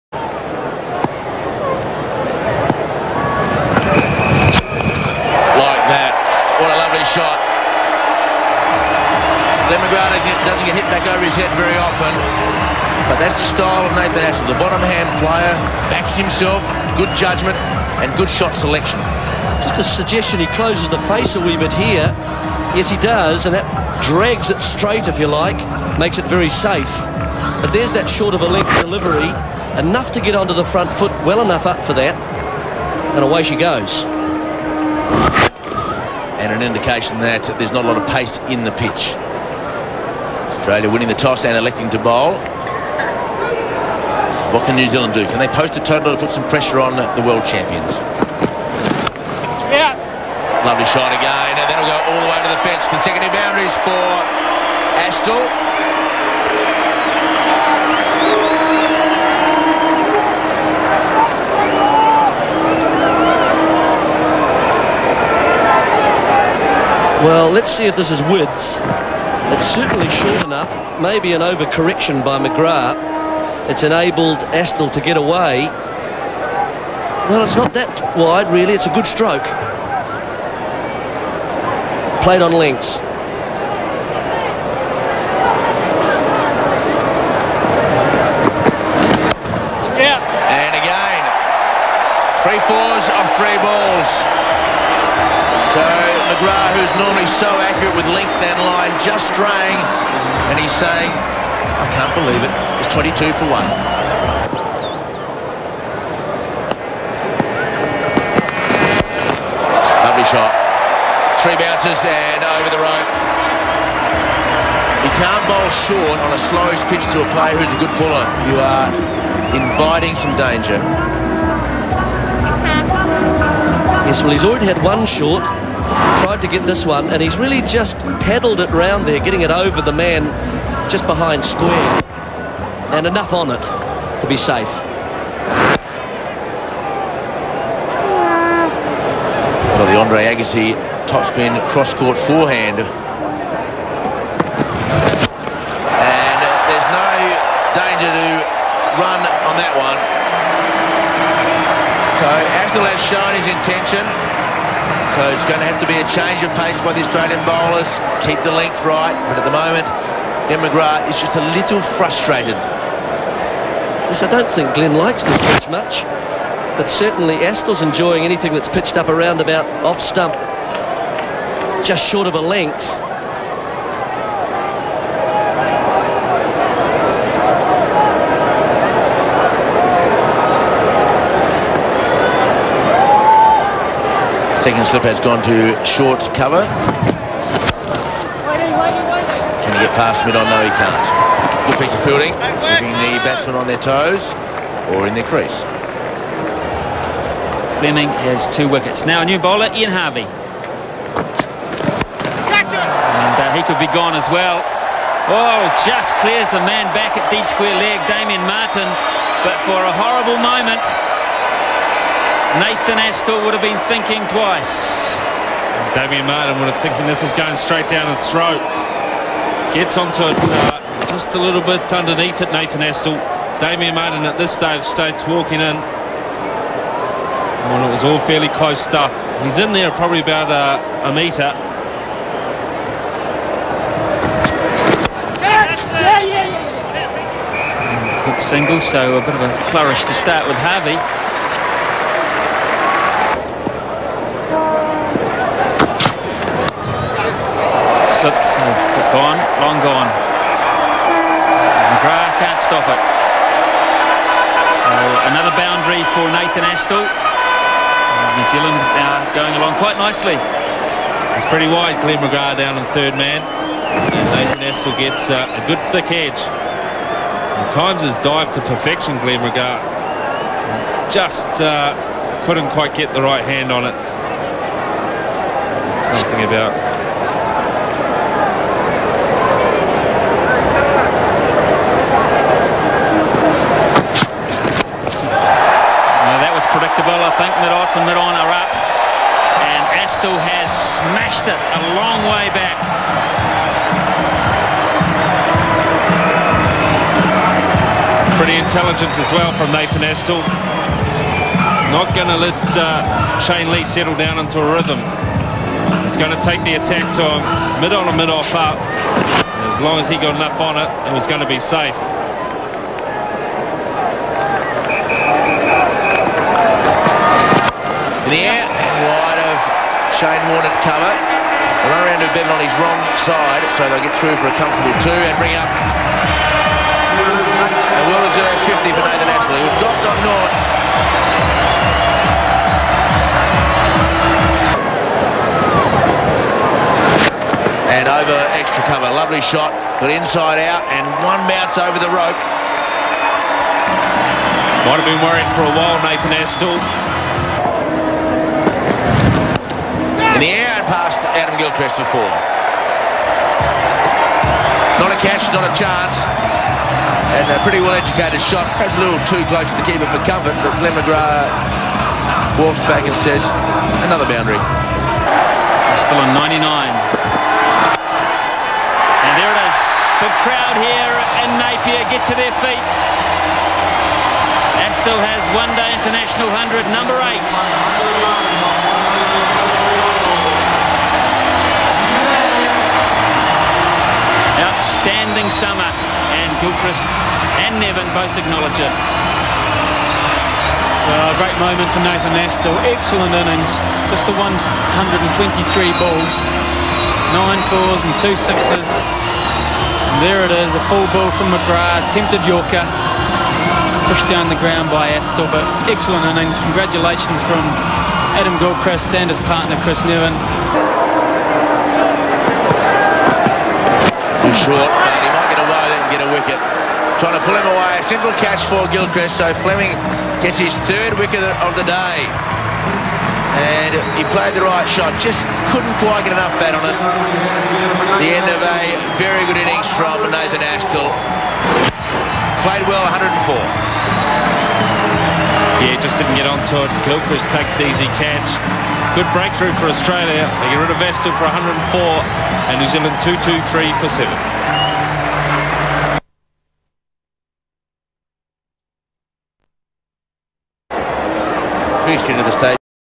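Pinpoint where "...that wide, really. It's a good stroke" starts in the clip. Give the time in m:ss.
1:17.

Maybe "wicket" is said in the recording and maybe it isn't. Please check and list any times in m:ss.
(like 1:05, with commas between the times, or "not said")
3:18, 6:56, 7:01.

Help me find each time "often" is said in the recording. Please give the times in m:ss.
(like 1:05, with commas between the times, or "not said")
0:11.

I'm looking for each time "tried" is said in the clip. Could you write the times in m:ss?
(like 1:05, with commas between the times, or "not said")
2:06.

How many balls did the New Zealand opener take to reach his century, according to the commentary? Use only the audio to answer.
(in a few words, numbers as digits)
123.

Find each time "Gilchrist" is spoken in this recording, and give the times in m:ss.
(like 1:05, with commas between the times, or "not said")
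5:51, 6:26, 6:48, 6:58, 7:17.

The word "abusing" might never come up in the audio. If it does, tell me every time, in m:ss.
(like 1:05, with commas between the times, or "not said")
not said.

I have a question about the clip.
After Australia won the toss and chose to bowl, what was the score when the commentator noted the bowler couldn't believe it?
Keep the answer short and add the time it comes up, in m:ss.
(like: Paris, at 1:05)
22 for 1, at 1:42.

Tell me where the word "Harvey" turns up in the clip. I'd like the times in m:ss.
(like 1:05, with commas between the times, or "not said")
3:19, 4:00.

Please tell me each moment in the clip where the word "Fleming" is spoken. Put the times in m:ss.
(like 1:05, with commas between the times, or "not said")
3:17, 6:59.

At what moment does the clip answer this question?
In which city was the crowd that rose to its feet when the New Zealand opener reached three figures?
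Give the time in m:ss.
6:11.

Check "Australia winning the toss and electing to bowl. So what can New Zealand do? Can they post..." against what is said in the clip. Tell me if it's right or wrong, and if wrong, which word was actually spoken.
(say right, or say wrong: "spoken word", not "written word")
right.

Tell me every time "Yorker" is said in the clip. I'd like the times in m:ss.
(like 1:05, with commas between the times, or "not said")
6:42.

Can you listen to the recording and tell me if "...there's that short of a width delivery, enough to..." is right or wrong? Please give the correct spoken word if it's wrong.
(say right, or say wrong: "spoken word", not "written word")
wrong: "length", not "width".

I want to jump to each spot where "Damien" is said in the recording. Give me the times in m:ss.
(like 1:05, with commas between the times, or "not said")
3:28, 3:35, 3:43.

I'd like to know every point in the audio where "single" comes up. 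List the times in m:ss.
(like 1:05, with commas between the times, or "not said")
3:58.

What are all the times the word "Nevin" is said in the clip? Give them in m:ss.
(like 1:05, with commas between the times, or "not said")
6:27, 6:50.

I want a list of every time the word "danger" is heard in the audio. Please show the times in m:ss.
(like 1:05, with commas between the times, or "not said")
2:00, 2:27.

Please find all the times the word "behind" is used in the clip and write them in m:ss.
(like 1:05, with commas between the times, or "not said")
2:11.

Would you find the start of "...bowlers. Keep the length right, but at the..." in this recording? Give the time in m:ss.
2:37.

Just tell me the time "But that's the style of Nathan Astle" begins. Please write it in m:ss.
0:13.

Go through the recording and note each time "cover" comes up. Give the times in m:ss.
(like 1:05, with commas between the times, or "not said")
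3:06, 5:20, 5:38.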